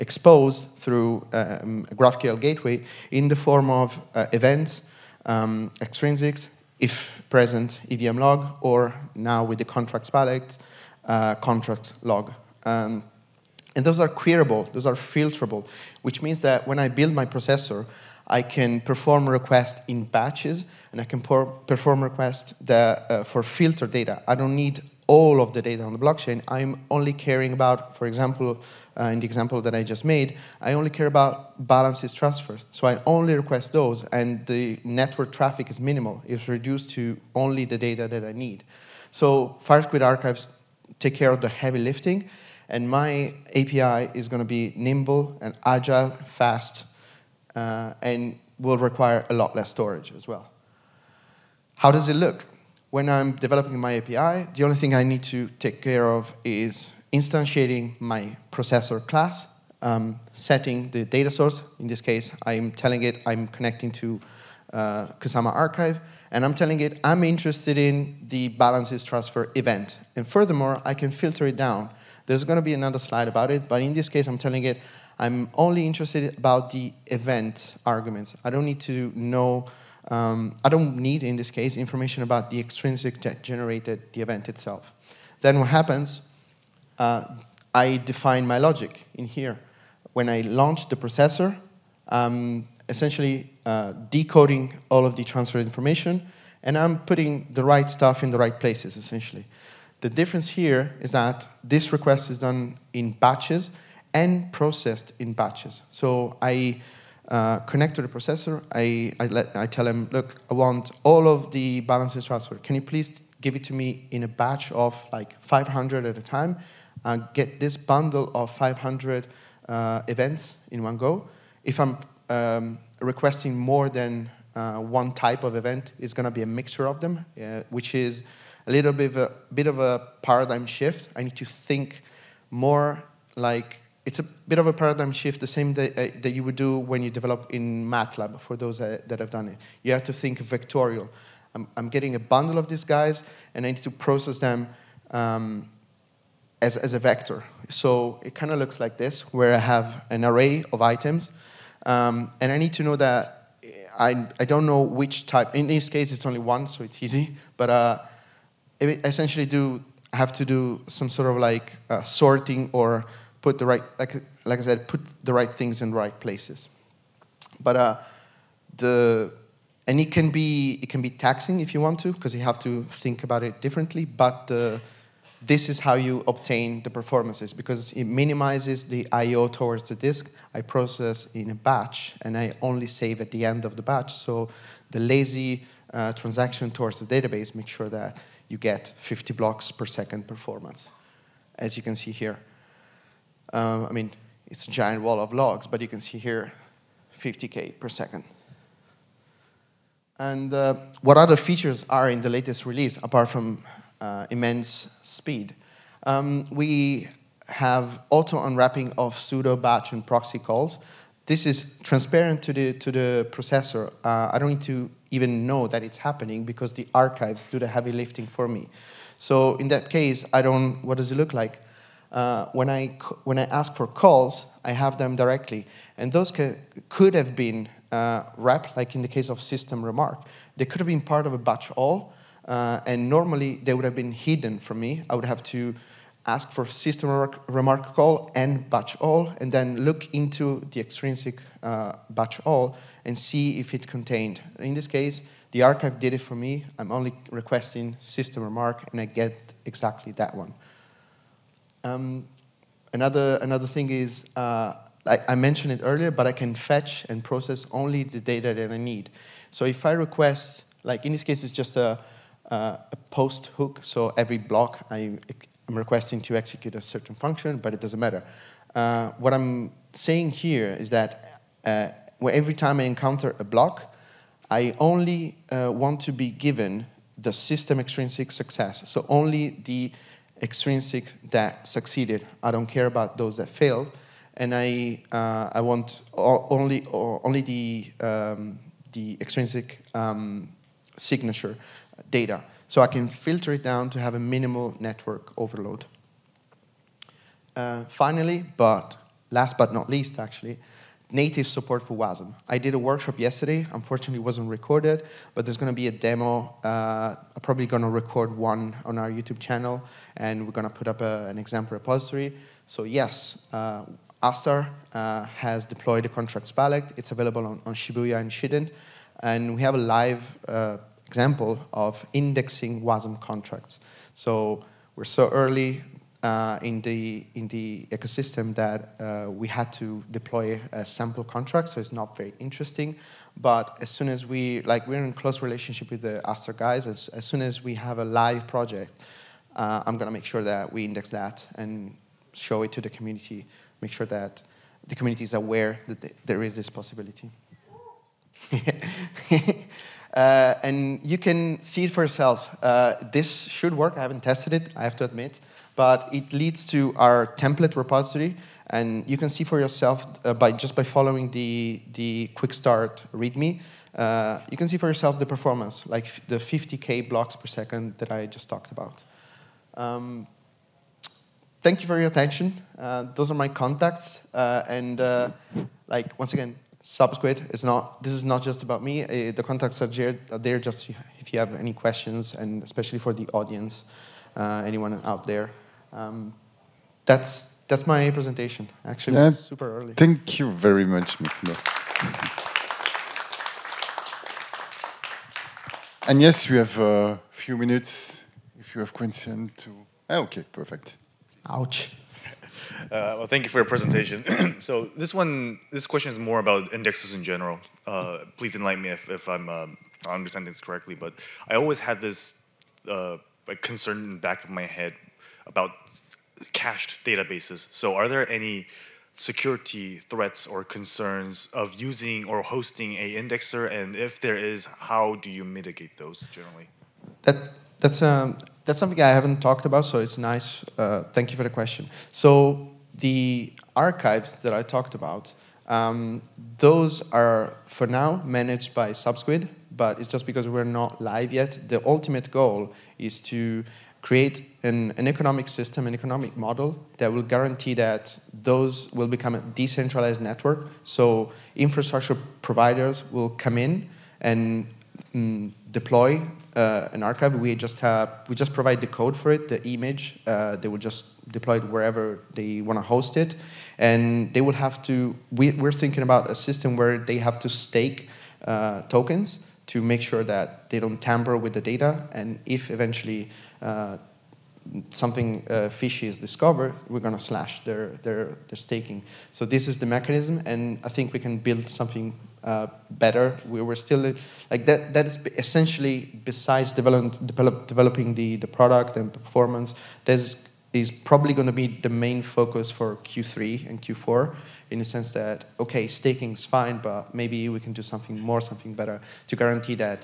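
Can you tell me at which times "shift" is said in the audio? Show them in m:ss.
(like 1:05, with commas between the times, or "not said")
2:10, 2:15.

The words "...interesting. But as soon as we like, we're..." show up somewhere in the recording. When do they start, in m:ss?
5:32.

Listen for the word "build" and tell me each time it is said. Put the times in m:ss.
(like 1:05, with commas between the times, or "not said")
0:16, 8:01.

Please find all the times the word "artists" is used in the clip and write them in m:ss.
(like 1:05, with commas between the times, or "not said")
not said.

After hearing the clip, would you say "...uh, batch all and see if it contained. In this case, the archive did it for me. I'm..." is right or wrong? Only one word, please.
right.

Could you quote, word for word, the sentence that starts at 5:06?
Uh, I'm probably going to record one on our YouTube channel, and we're going to put up a, an example repository.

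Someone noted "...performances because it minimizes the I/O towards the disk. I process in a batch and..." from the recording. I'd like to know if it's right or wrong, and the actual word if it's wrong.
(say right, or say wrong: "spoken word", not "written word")
right.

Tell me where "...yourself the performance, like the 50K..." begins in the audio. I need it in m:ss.
6:04.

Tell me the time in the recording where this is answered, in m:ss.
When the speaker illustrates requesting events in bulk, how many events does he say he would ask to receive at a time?
1:55.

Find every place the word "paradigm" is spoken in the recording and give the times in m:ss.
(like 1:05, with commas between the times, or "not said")
2:10, 2:14.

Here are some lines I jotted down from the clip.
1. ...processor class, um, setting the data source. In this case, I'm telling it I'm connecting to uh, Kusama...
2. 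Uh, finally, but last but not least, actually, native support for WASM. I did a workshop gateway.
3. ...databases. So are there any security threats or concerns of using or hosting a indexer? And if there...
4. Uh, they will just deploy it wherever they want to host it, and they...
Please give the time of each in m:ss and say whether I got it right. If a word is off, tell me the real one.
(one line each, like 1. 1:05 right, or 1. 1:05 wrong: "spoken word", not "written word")
1. 0:58 right
2. 4:57 wrong: "yesterday", not "gateway"
3. 6:57 right
4. 7:40 right.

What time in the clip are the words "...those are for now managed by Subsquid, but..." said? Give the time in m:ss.
7:16.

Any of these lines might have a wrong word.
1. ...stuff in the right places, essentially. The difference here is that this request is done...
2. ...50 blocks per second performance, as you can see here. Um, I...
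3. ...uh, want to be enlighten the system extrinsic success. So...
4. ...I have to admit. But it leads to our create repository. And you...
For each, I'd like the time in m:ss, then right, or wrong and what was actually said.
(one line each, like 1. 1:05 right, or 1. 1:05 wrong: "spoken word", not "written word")
1. 1:37 right
2. 3:08 right
3. 4:35 wrong: "given", not "enlighten"
4. 5:54 wrong: "template", not "create".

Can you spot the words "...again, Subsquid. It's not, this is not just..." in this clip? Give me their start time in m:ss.
6:16.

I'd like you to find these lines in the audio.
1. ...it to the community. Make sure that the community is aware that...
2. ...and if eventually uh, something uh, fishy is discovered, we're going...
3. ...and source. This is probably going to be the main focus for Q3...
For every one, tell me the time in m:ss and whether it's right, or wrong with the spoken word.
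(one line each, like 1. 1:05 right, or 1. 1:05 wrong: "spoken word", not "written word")
1. 5:42 right
2. 7:52 right
3. 8:08 wrong: "performance", not "source".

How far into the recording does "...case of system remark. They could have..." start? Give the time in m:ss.
3:49.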